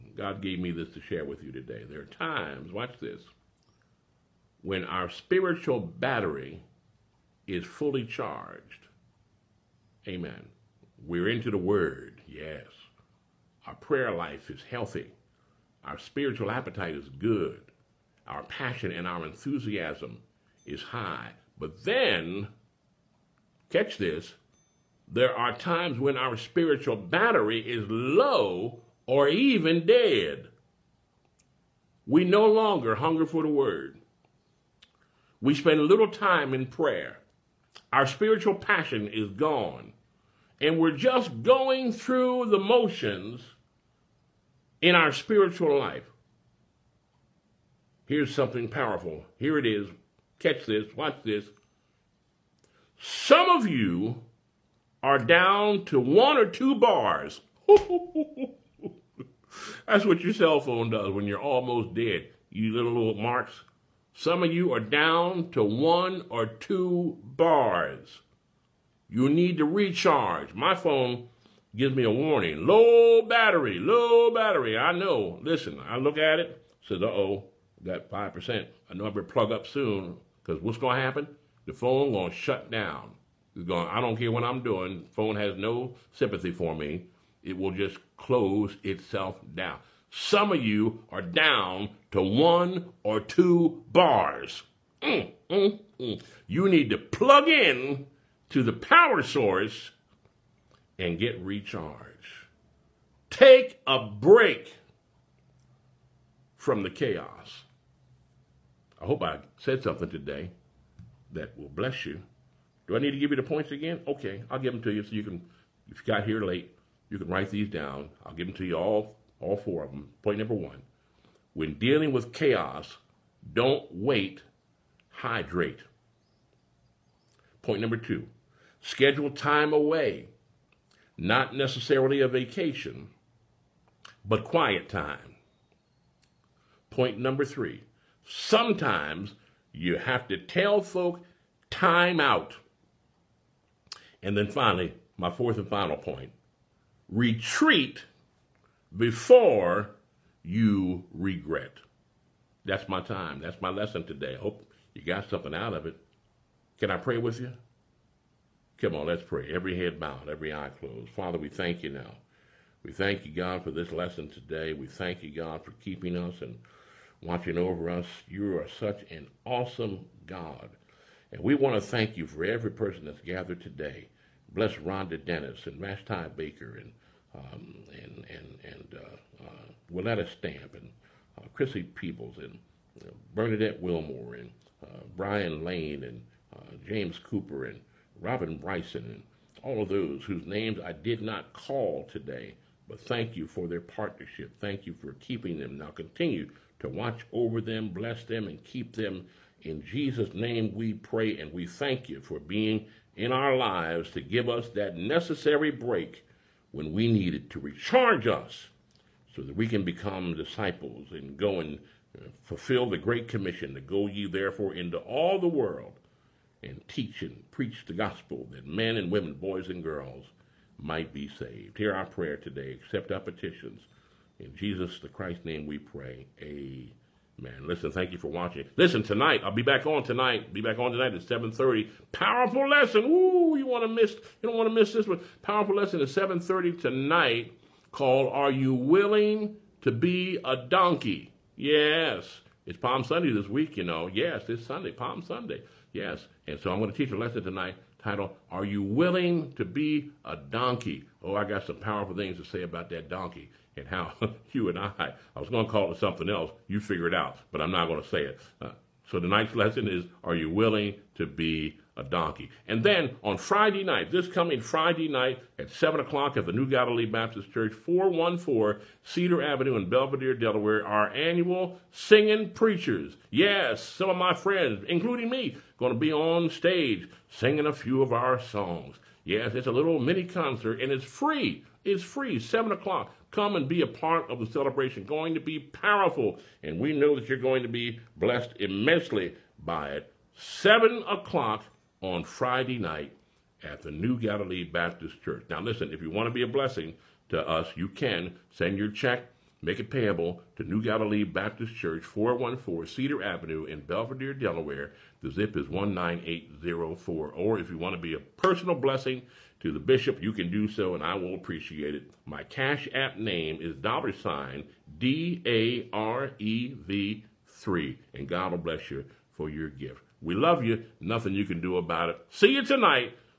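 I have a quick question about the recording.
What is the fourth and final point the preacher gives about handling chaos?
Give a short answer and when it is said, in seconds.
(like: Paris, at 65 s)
Retreat before you regret, at 147 s.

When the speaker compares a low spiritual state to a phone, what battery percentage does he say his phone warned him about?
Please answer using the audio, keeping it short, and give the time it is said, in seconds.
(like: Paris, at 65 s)
5%, at 78 s.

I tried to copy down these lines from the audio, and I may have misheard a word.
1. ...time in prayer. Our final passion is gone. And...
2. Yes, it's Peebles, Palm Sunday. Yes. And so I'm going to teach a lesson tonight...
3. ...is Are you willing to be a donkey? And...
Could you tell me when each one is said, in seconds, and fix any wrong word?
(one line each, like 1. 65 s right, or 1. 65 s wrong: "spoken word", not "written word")
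1. 36 s wrong: "spiritual", not "final"
2. 244 s wrong: "Sunday", not "Peebles"
3. 259 s right.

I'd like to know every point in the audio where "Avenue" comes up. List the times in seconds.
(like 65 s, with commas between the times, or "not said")
269 s, 303 s.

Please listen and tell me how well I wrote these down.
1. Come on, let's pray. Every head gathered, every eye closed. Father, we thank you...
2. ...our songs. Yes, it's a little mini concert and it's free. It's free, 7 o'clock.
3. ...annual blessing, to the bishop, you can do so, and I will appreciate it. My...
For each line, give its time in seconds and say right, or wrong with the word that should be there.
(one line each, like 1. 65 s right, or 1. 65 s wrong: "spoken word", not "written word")
1. 158 s wrong: "bowed", not "gathered"
2. 278 s right
3. 308 s wrong: "personal", not "annual".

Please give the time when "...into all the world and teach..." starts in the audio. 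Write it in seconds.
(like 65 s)
214 s.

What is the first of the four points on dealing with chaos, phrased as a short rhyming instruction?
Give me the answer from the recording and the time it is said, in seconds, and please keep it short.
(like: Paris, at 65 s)
Don't wait, hydrate, at 123 s.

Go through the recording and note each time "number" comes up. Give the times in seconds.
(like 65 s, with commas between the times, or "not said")
120 s, 127 s, 137 s.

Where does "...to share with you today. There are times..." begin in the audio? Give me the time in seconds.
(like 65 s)
0 s.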